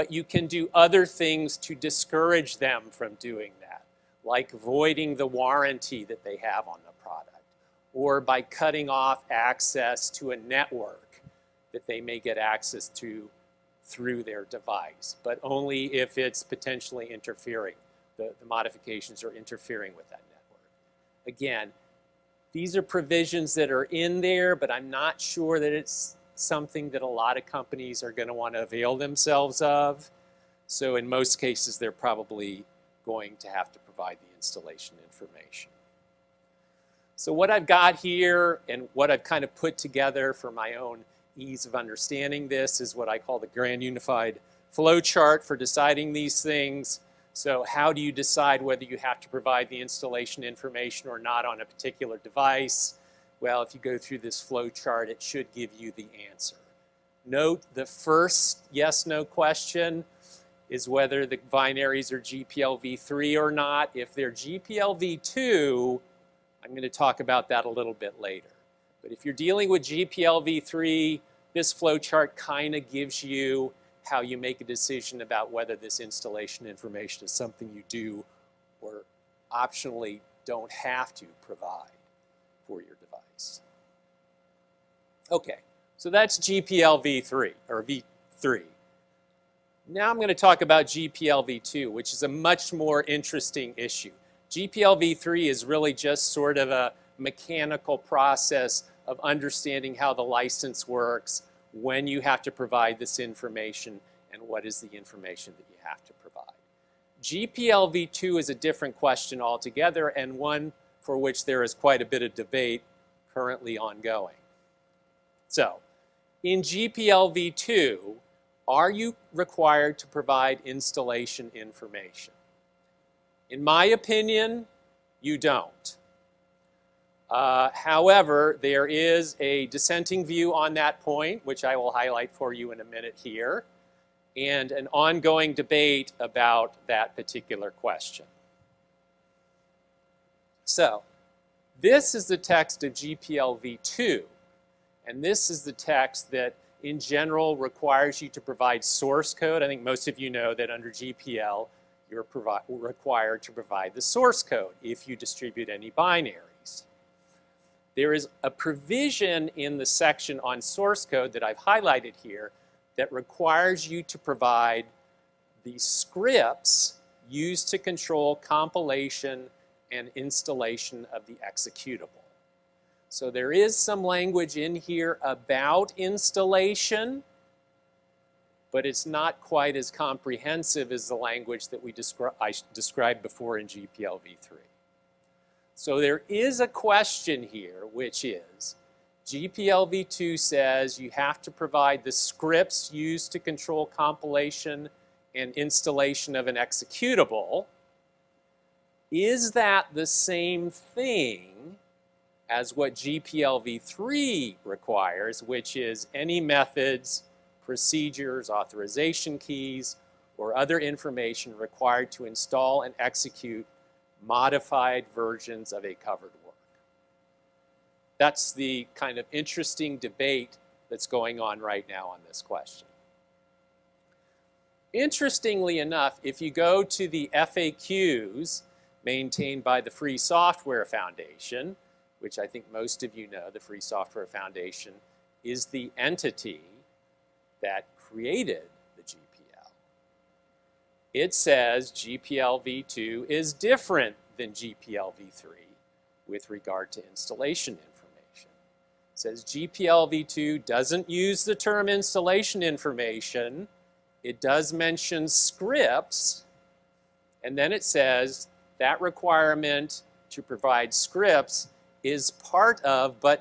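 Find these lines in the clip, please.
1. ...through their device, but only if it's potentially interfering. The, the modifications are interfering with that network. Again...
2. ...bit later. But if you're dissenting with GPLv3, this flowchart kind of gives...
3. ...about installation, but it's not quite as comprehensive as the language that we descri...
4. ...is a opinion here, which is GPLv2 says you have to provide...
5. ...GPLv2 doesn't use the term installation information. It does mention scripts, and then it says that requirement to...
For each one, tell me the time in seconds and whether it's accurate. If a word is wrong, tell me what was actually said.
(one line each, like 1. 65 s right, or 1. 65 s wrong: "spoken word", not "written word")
1. 13 s right
2. 67 s wrong: "dealing", not "dissenting"
3. 175 s right
4. 186 s wrong: "question", not "opinion"
5. 249 s right.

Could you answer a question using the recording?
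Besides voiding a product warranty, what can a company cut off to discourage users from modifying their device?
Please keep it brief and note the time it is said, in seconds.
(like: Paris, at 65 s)
access to a network, at 9 s.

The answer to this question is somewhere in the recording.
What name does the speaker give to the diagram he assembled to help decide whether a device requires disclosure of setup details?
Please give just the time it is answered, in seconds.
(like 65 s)
43 s.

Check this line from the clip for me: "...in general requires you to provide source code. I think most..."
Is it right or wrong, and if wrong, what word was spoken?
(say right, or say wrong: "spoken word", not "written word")
right.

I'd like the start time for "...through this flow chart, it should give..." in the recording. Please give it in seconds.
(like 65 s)
53 s.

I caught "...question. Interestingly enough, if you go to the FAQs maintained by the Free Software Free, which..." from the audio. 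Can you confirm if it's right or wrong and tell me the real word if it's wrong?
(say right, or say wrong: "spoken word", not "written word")
wrong: "Foundation", not "Free".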